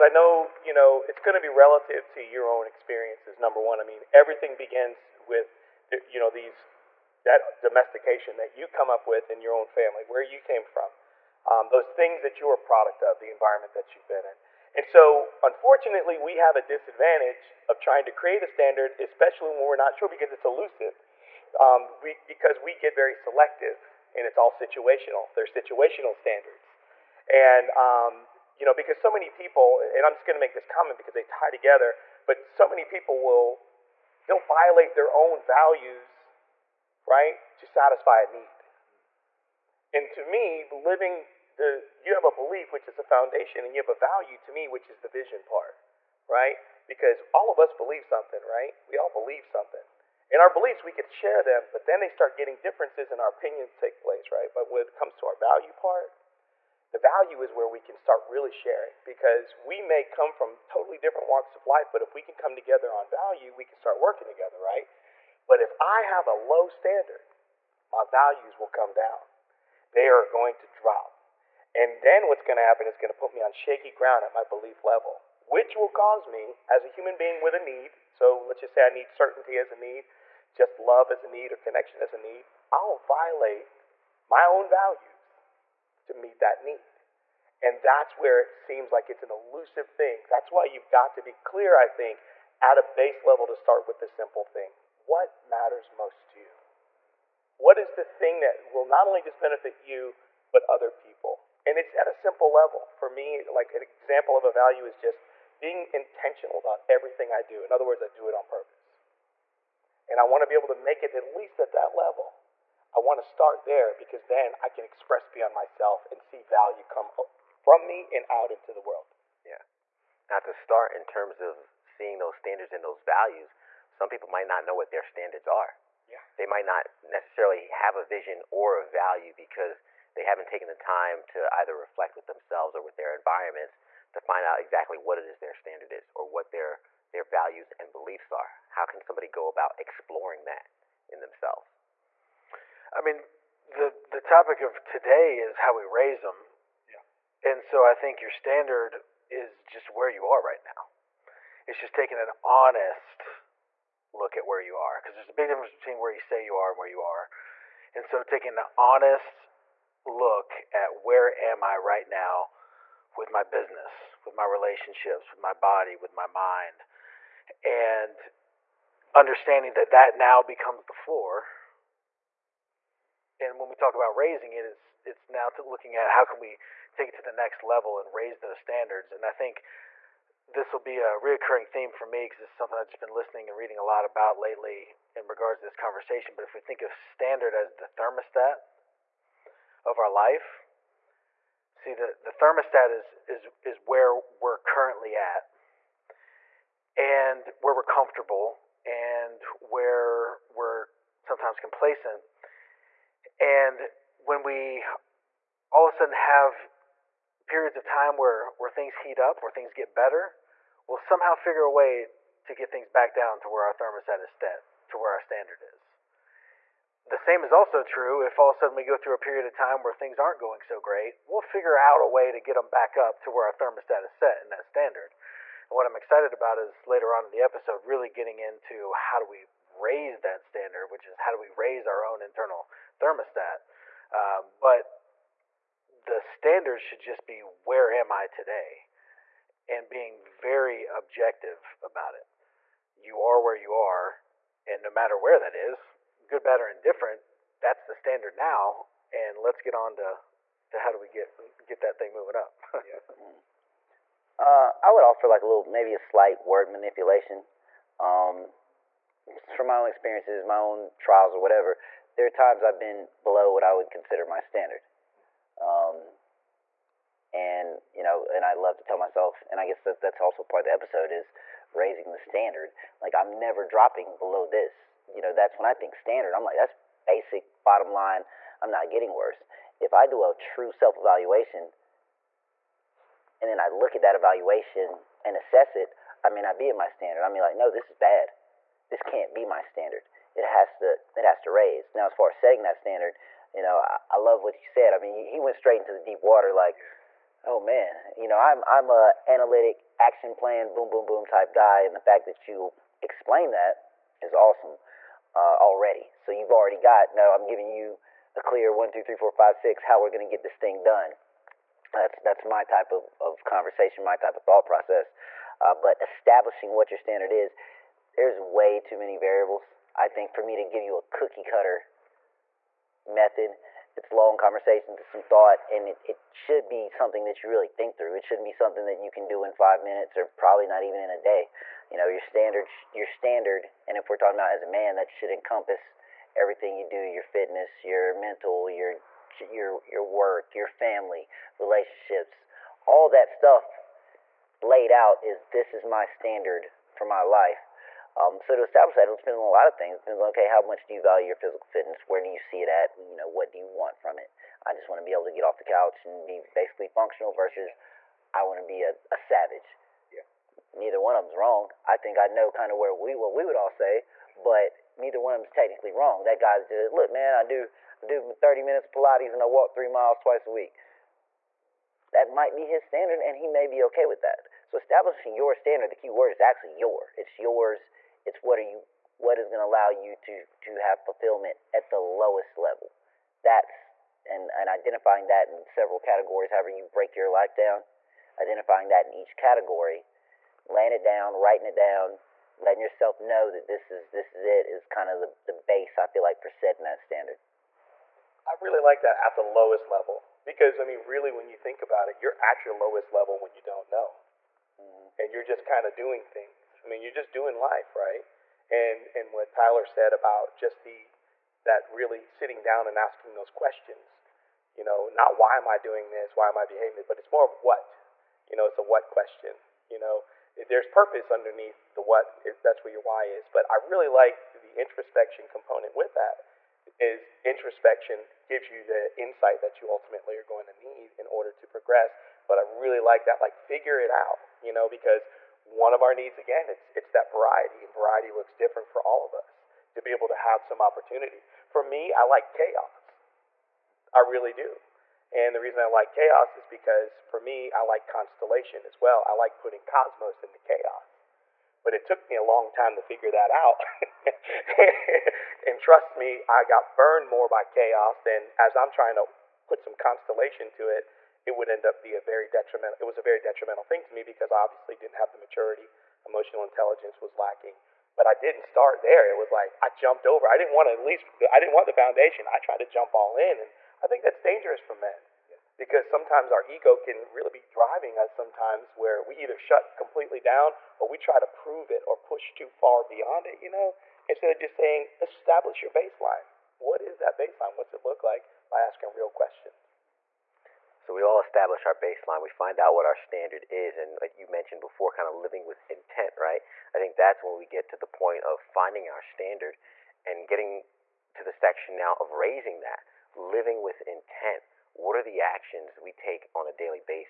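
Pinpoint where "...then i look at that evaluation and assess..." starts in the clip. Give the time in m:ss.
4:43.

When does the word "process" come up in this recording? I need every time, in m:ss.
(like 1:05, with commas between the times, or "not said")
5:14.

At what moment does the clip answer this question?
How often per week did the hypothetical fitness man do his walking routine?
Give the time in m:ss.
6:10.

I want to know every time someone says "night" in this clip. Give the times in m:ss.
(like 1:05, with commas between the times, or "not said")
not said.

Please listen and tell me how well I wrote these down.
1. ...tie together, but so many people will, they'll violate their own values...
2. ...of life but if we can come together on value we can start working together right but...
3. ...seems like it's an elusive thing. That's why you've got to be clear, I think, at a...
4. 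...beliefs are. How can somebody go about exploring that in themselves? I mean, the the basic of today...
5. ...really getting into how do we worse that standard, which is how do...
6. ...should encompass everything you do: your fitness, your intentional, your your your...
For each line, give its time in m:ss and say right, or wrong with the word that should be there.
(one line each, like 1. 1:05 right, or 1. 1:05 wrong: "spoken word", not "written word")
1. 0:31 right
2. 1:01 right
3. 1:28 right
4. 2:17 wrong: "topic", not "basic"
5. 3:47 wrong: "raise", not "worse"
6. 5:35 wrong: "mental", not "intentional".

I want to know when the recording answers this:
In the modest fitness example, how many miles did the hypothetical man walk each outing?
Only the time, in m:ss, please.
6:09.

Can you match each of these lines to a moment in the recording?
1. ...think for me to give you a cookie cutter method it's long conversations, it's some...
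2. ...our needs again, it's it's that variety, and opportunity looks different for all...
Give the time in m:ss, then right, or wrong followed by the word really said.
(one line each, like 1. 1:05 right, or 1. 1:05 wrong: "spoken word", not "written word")
1. 5:20 right
2. 7:16 wrong: "variety", not "opportunity".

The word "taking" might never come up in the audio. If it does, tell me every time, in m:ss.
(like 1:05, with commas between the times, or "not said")
2:31, 2:38.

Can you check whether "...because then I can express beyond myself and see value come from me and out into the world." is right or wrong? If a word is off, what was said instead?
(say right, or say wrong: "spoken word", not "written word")
right.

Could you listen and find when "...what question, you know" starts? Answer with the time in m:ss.
6:58.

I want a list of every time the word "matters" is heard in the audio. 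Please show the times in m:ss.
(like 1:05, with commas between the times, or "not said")
1:35, 4:04.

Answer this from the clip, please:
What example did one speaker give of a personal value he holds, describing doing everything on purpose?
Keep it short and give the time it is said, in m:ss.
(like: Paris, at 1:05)
Being intentional, at 1:45.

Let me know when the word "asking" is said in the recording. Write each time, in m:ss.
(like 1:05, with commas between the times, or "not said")
6:52, 8:08.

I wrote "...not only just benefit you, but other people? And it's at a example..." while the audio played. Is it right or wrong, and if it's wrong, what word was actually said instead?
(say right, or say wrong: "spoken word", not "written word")
wrong: "simple", not "example".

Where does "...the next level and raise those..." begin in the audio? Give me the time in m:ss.
2:57.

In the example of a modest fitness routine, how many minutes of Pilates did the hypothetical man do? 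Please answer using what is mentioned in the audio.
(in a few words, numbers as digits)
30.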